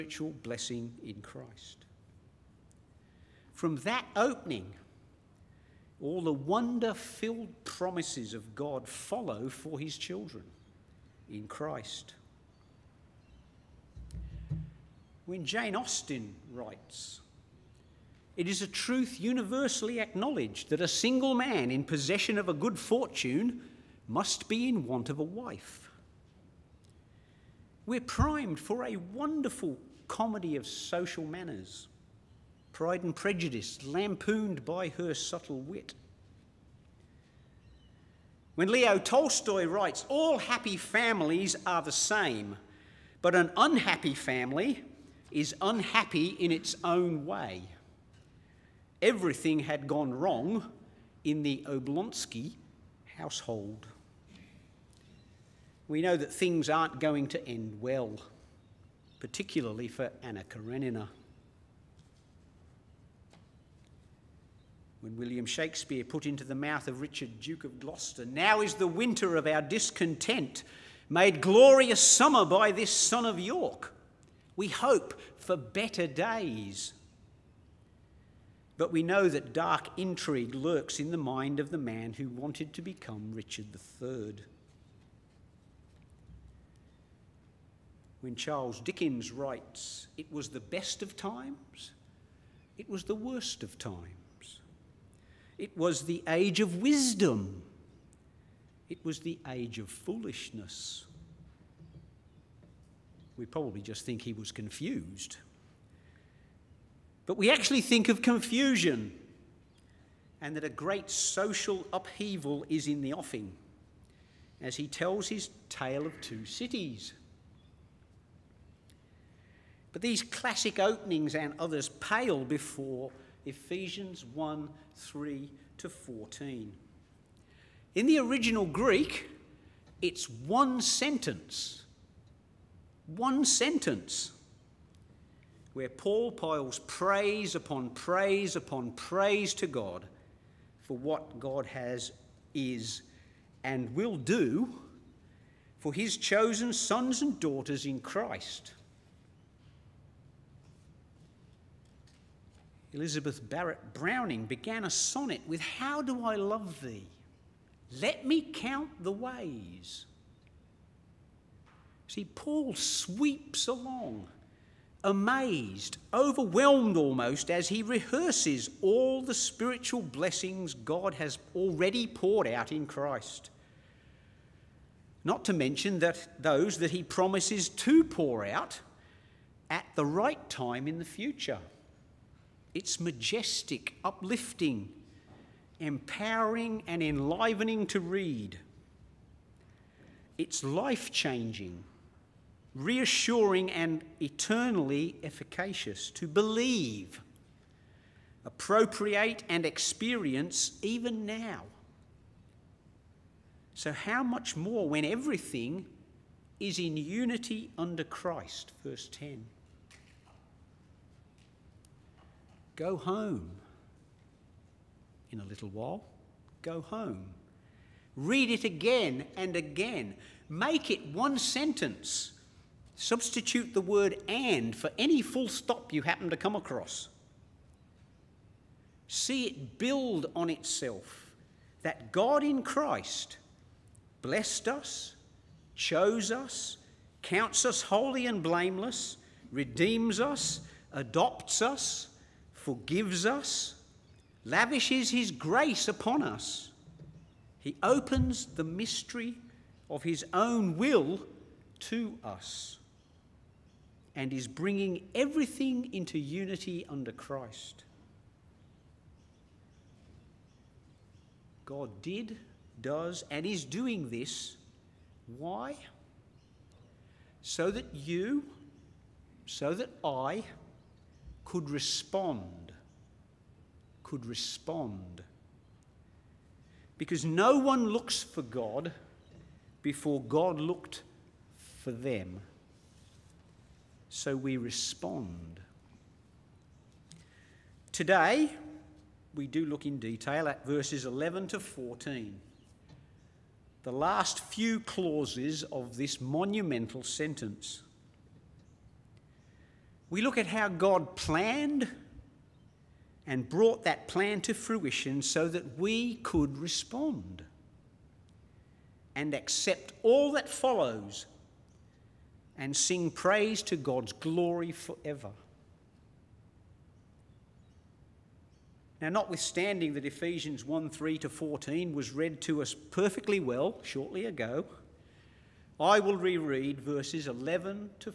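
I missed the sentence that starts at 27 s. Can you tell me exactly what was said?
We're primed for a wonderful comedy of social manners, Pride and Prejudice, lampooned by her subtle wit.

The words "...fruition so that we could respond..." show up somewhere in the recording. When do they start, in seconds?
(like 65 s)
304 s.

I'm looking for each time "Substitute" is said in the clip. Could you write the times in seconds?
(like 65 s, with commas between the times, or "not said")
222 s.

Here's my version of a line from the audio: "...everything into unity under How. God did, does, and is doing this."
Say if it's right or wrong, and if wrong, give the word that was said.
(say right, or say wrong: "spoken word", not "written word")
wrong: "Christ", not "How".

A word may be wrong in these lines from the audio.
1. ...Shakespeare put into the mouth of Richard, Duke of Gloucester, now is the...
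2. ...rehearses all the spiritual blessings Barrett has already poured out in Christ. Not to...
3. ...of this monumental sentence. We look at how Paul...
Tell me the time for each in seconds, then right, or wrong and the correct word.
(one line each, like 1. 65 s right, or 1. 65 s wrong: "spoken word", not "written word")
1. 65 s right
2. 167 s wrong: "God", not "Barrett"
3. 295 s wrong: "God", not "Paul".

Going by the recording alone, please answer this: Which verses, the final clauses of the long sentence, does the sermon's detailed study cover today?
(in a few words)
11 to 14.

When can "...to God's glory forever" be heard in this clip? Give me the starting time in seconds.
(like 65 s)
313 s.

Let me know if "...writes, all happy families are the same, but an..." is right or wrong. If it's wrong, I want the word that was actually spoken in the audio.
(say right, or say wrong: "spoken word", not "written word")
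right.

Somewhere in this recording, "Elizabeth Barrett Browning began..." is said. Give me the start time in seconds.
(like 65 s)
152 s.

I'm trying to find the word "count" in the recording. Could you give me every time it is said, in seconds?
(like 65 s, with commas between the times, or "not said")
158 s, 237 s.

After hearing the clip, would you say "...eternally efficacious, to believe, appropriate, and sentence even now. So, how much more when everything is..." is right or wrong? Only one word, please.
wrong.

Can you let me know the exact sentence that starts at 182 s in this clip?
It's majestic, uplifting, empowering, and enlivening to read.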